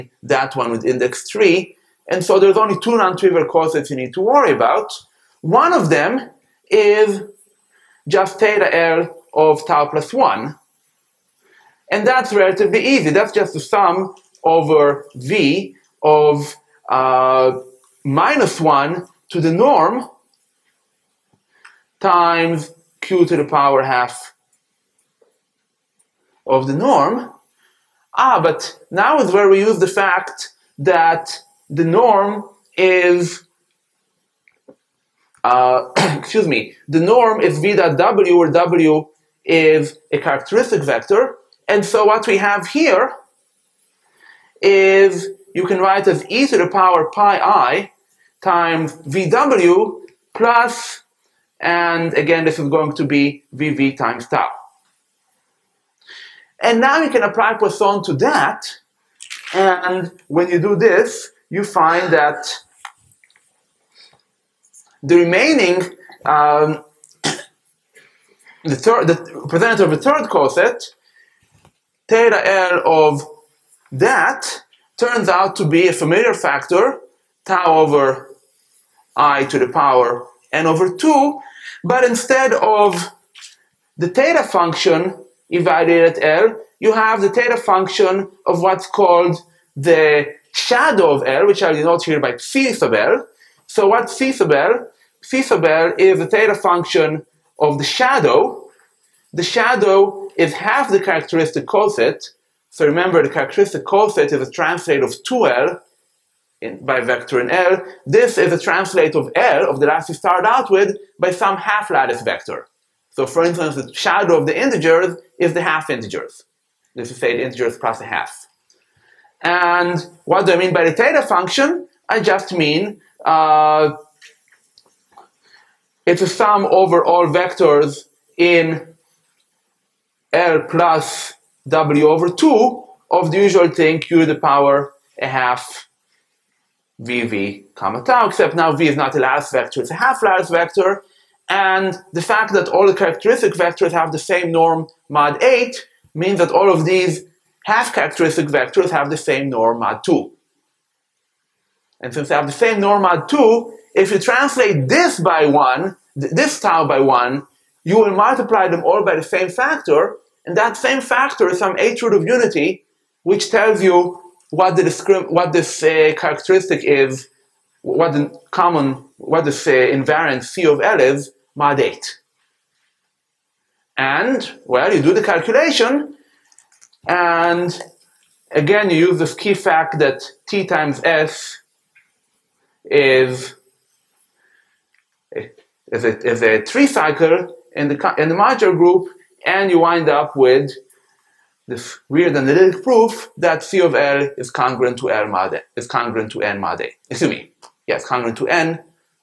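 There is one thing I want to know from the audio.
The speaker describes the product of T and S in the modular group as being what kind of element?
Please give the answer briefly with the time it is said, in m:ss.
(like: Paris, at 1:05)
a three cycle, at 3:06.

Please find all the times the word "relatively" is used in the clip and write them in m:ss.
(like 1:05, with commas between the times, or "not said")
0:12.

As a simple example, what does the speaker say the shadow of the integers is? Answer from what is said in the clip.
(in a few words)
the half integers.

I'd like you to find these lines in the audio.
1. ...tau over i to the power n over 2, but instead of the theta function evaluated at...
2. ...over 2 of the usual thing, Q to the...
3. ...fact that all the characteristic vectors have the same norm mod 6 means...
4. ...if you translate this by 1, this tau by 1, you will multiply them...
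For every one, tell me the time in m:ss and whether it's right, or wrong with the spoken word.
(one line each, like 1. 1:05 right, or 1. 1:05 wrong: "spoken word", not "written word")
1. 1:17 right
2. 2:12 right
3. 2:22 wrong: "8", not "6"
4. 2:33 right.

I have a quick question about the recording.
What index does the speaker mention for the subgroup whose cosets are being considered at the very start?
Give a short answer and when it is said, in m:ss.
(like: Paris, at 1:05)
3, at 0:00.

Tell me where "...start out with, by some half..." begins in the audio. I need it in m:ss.
1:50.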